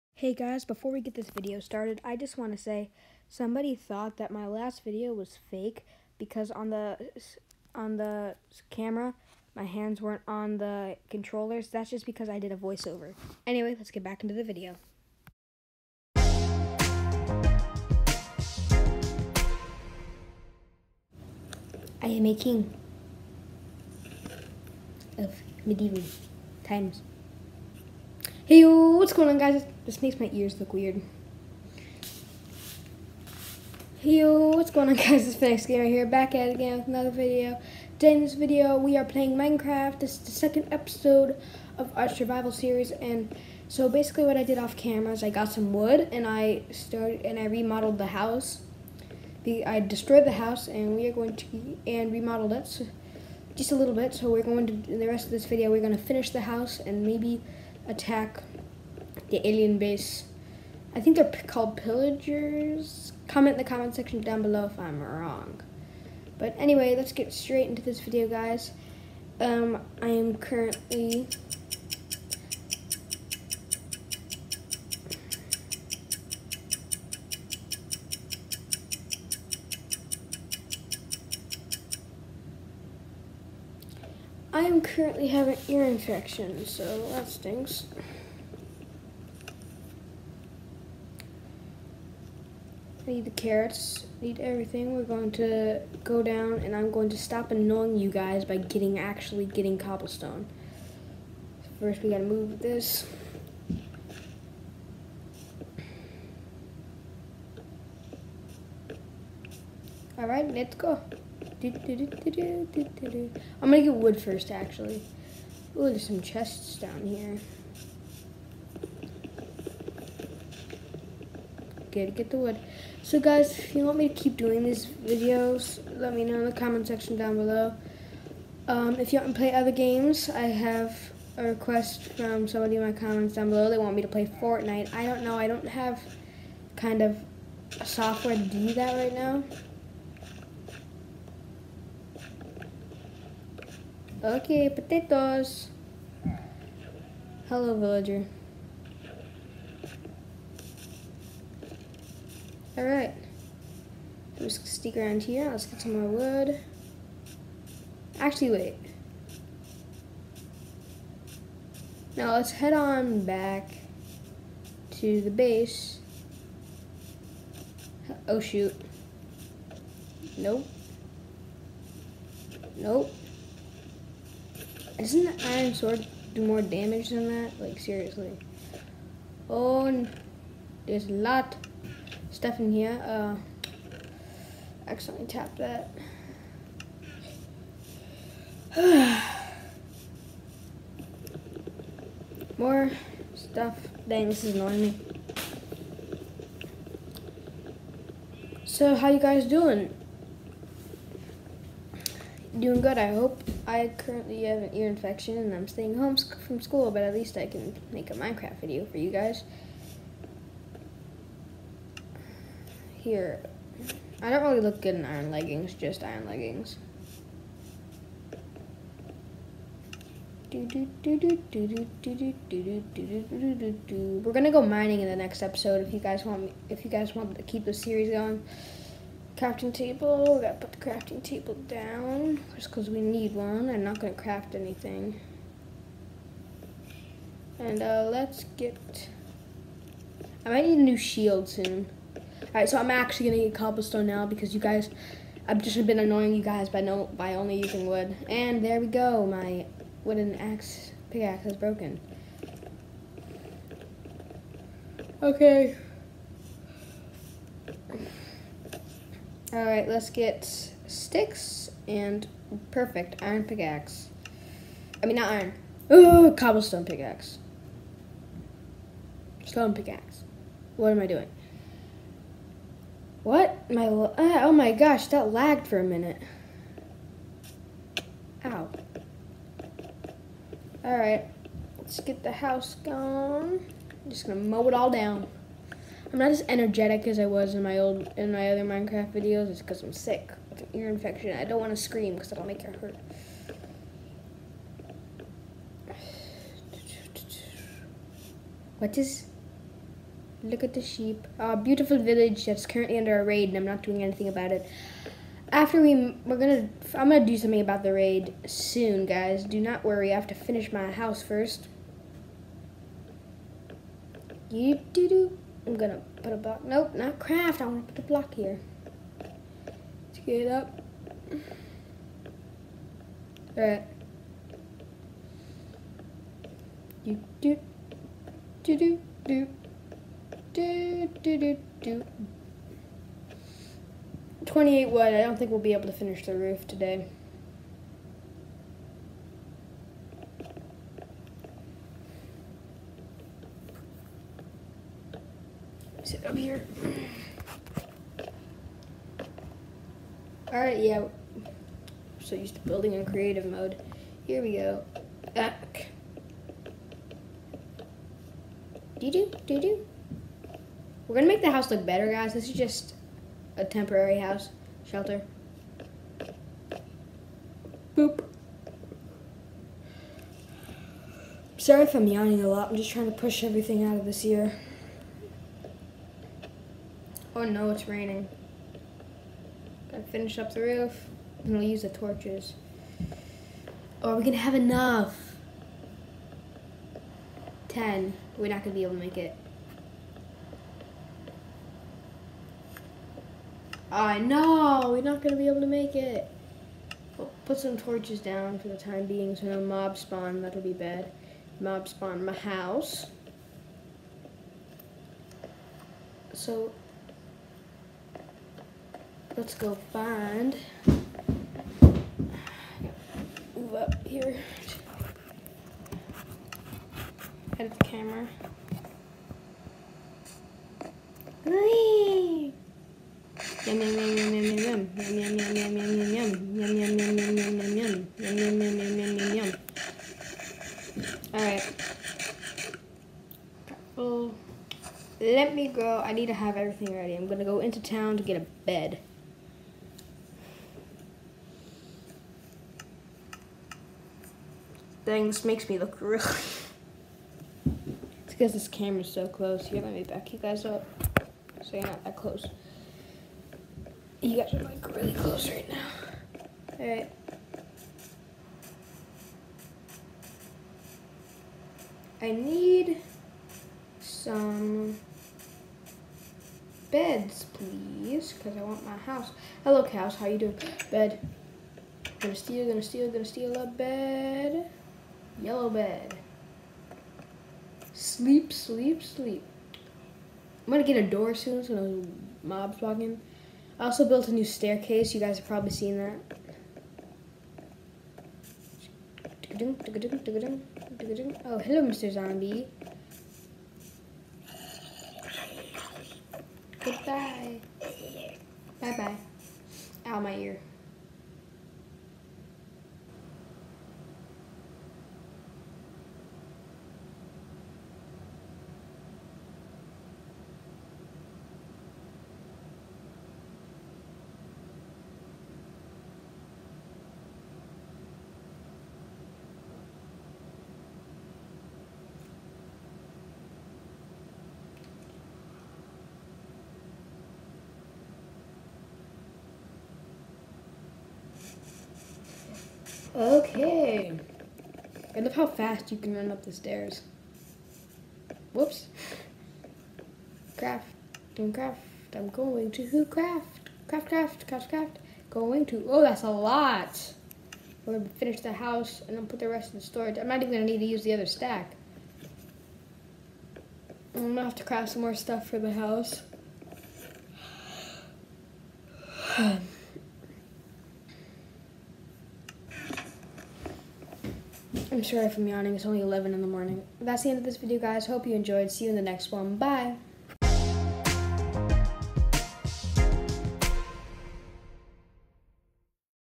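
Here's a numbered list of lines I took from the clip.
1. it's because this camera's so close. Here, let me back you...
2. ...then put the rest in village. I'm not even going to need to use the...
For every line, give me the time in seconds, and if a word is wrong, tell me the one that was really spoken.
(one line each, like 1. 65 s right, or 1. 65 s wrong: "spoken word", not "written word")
1. 447 s right
2. 549 s wrong: "storage", not "village".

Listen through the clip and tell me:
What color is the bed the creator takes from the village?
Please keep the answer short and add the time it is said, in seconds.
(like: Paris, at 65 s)
Yellow, at 475 s.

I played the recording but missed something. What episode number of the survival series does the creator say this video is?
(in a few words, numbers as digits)
Second.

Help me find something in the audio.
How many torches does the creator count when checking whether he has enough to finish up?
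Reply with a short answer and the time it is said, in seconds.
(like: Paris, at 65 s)
10, at 387 s.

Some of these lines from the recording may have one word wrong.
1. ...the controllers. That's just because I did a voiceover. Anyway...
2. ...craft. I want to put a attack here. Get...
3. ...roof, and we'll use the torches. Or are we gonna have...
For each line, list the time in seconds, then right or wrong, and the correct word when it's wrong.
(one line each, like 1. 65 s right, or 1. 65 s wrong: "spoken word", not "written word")
1. 10 s right
2. 317 s wrong: "block", not "attack"
3. 380 s right.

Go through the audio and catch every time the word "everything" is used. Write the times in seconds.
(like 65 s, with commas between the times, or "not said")
94 s, 373 s.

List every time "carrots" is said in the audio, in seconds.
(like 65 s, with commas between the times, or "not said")
93 s.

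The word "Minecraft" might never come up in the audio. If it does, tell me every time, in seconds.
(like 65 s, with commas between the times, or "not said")
39 s, 208 s, 288 s.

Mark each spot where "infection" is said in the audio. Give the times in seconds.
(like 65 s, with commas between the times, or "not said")
85 s, 204 s, 290 s.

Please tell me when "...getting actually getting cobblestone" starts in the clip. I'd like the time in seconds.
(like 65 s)
98 s.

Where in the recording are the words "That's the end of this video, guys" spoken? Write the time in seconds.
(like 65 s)
566 s.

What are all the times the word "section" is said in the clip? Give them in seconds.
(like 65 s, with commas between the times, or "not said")
63 s, 126 s.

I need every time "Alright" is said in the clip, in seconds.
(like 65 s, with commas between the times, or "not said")
110 s, 152 s, 242 s, 350 s.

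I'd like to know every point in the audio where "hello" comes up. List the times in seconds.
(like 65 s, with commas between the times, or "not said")
147 s, 469 s, 491 s.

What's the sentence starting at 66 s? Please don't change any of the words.
But anyway, let's get straight into this video, guys.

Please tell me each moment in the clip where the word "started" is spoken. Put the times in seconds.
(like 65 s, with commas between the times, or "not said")
1 s, 46 s.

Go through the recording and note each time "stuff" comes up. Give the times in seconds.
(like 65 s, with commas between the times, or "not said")
182 s, 193 s, 555 s.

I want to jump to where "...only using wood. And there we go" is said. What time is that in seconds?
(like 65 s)
247 s.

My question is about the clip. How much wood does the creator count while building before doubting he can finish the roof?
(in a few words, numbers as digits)
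28.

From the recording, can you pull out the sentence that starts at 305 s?
After we, we're gonna, I'm gonna do something about the raid soon, guys.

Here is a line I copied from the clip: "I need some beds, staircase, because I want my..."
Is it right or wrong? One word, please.
wrong.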